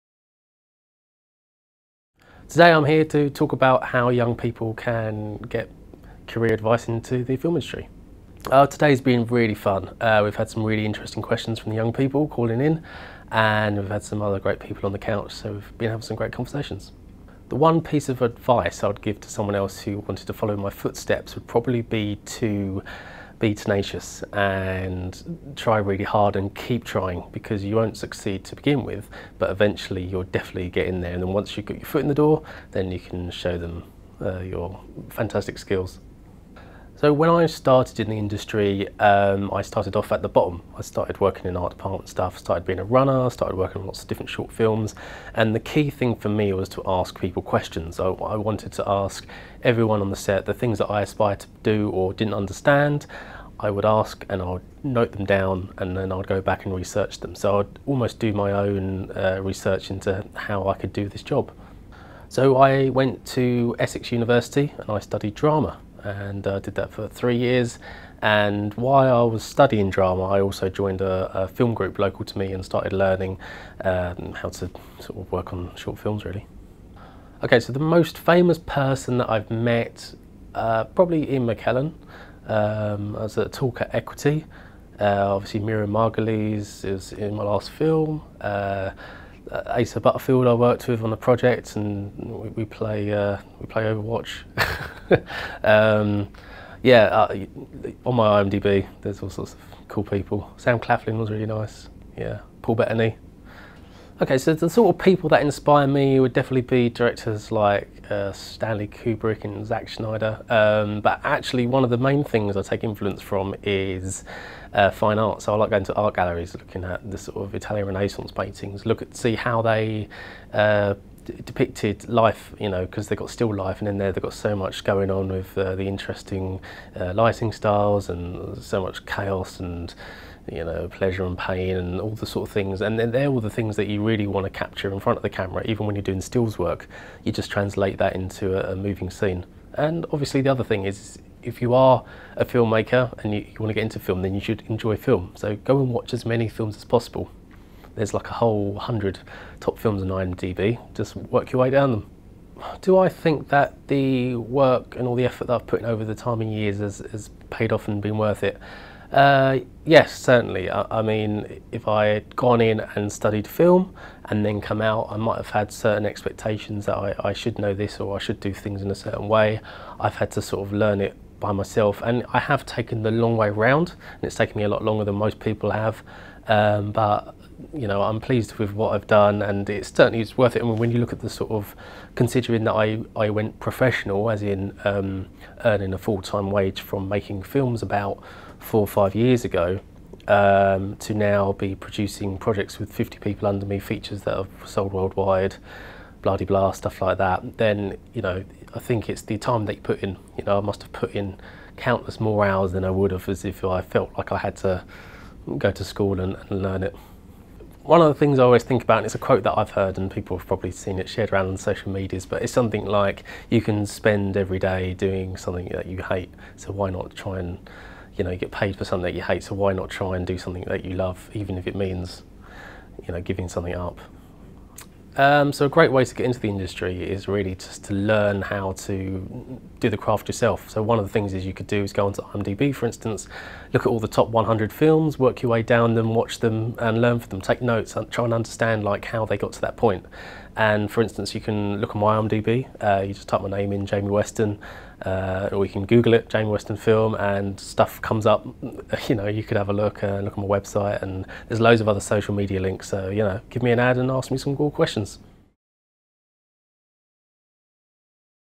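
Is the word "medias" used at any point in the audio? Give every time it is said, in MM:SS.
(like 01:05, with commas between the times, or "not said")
03:31, 04:12.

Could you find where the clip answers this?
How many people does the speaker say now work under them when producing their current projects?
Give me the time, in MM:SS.
03:12.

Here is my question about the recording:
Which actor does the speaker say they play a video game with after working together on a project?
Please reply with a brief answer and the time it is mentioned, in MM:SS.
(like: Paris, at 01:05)
Asa Butterfield, at 01:29.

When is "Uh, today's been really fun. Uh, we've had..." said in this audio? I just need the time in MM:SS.
00:08.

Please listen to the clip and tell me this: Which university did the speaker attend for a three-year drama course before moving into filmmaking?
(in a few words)
Essex University.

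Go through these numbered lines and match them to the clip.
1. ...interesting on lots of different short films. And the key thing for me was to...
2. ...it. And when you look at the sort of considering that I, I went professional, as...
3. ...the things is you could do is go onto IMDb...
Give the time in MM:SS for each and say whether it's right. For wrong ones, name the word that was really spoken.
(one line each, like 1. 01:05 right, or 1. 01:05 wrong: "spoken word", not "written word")
1. 00:43 wrong: "working", not "interesting"
2. 03:00 right
3. 03:51 right.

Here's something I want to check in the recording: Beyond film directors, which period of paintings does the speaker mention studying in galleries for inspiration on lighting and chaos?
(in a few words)
Italian Renaissance.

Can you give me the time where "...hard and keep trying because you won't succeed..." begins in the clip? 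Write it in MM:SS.
00:26.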